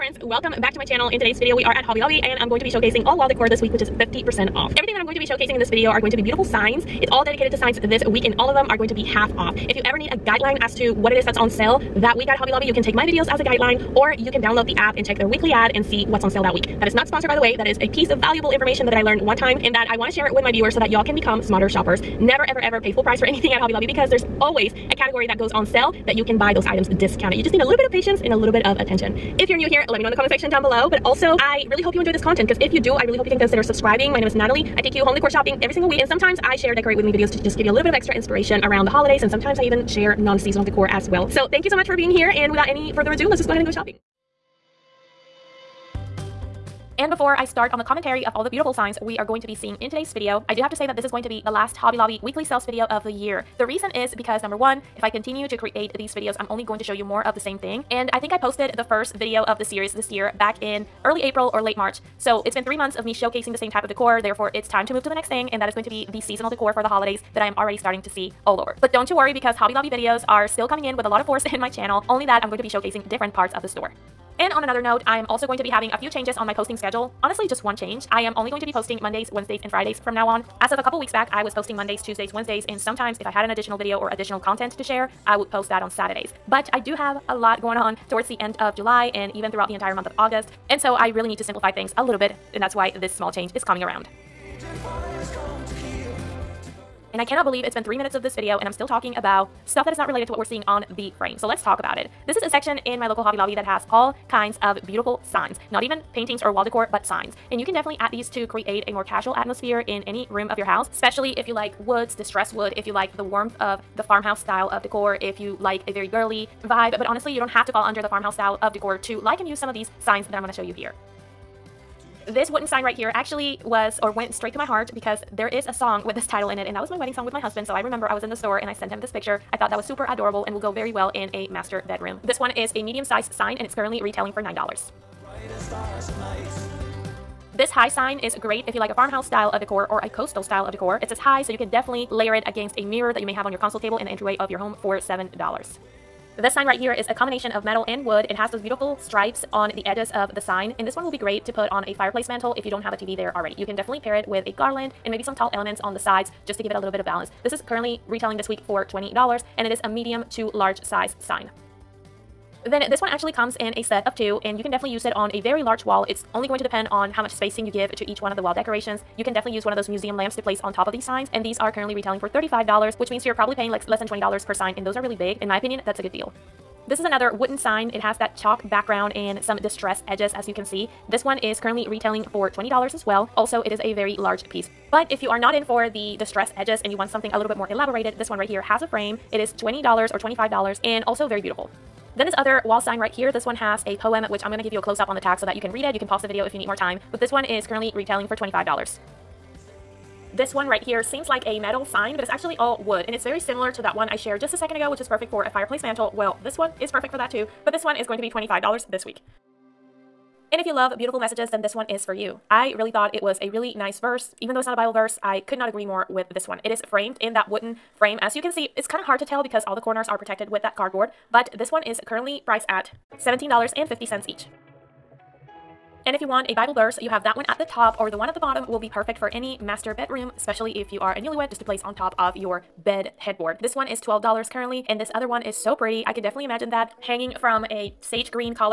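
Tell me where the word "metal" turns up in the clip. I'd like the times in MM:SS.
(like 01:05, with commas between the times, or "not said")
02:27, 03:21.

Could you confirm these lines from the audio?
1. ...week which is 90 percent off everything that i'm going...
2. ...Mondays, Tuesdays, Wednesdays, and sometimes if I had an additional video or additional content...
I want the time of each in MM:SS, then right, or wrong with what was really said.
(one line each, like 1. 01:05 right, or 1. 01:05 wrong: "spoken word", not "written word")
1. 00:03 wrong: "50", not "90"
2. 01:21 right.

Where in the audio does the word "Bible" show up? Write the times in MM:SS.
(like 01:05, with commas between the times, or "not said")
03:34, 03:46.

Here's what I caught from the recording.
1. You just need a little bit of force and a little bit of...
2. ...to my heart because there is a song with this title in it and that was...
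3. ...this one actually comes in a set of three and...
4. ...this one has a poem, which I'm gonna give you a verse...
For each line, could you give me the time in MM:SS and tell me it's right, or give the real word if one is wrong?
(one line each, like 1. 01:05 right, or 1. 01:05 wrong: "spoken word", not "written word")
1. 00:27 wrong: "patience", not "force"
2. 02:04 right
3. 02:42 wrong: "two", not "three"
4. 03:13 wrong: "close", not "verse".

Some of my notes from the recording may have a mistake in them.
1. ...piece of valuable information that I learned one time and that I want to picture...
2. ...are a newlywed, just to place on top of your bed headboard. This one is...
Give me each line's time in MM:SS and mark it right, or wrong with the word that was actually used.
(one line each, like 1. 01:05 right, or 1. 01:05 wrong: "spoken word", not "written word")
1. 00:17 wrong: "share", not "picture"
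2. 03:50 right.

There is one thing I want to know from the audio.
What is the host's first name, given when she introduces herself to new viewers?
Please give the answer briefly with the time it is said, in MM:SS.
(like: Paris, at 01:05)
Nathaly, at 00:34.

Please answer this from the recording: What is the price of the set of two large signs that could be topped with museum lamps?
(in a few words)
$35.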